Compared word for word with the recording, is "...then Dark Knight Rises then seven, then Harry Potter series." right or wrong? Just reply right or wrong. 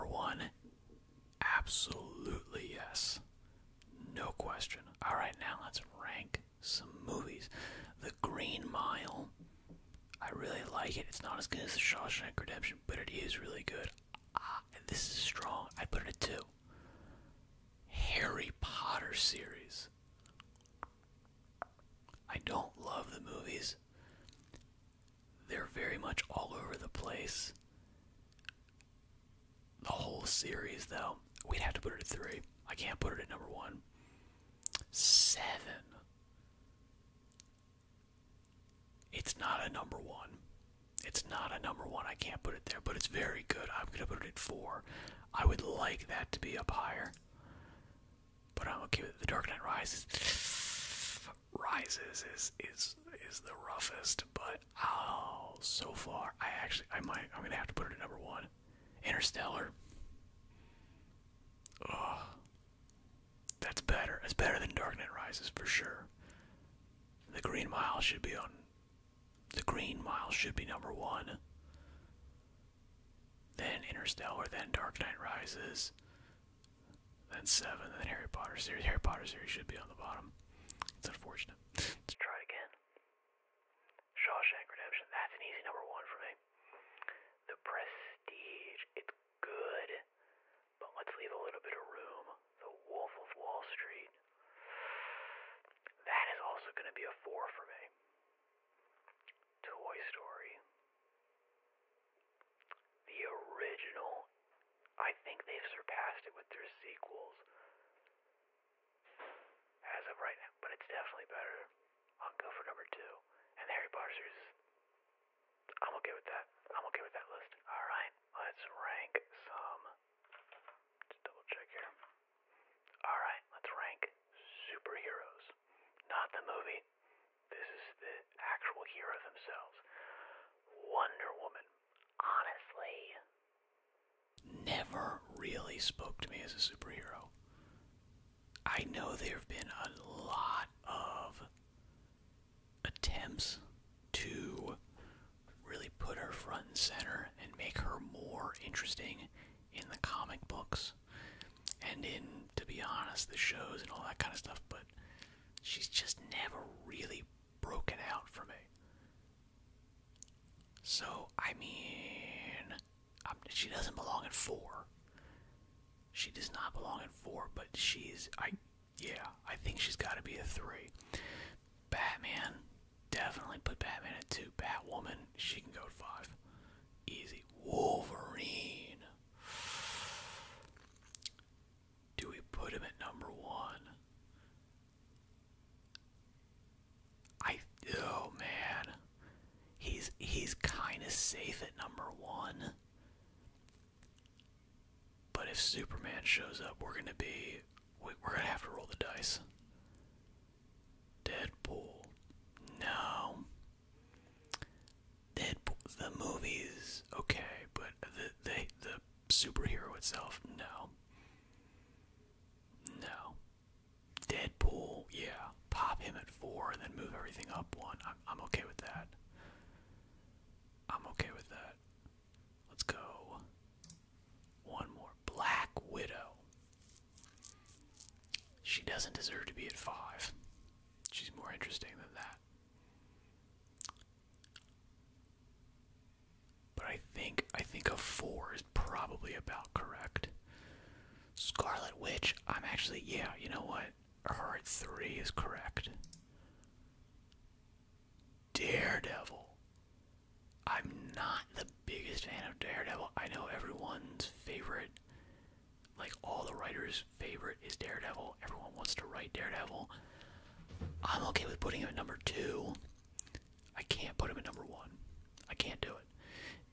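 right.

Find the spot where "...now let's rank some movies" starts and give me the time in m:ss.
0:05.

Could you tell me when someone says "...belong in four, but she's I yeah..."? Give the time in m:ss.
2:43.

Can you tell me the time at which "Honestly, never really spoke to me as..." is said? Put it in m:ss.
2:12.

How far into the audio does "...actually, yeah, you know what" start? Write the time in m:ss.
4:02.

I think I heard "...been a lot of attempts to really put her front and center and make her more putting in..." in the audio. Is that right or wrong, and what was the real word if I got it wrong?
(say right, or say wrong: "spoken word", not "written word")
wrong: "interesting", not "putting".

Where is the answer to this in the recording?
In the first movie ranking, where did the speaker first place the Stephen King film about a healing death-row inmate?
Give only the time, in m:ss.
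0:15.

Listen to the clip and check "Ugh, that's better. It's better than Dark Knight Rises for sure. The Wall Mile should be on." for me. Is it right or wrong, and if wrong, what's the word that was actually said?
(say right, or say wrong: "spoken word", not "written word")
wrong: "Green", not "Wall".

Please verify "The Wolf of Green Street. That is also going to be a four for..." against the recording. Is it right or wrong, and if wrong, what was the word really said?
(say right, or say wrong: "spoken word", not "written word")
wrong: "Wall", not "Green".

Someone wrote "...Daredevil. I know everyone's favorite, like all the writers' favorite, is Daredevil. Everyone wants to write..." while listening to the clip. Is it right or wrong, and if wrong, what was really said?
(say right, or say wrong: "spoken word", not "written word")
right.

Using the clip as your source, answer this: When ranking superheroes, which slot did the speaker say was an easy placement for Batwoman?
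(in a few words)
5.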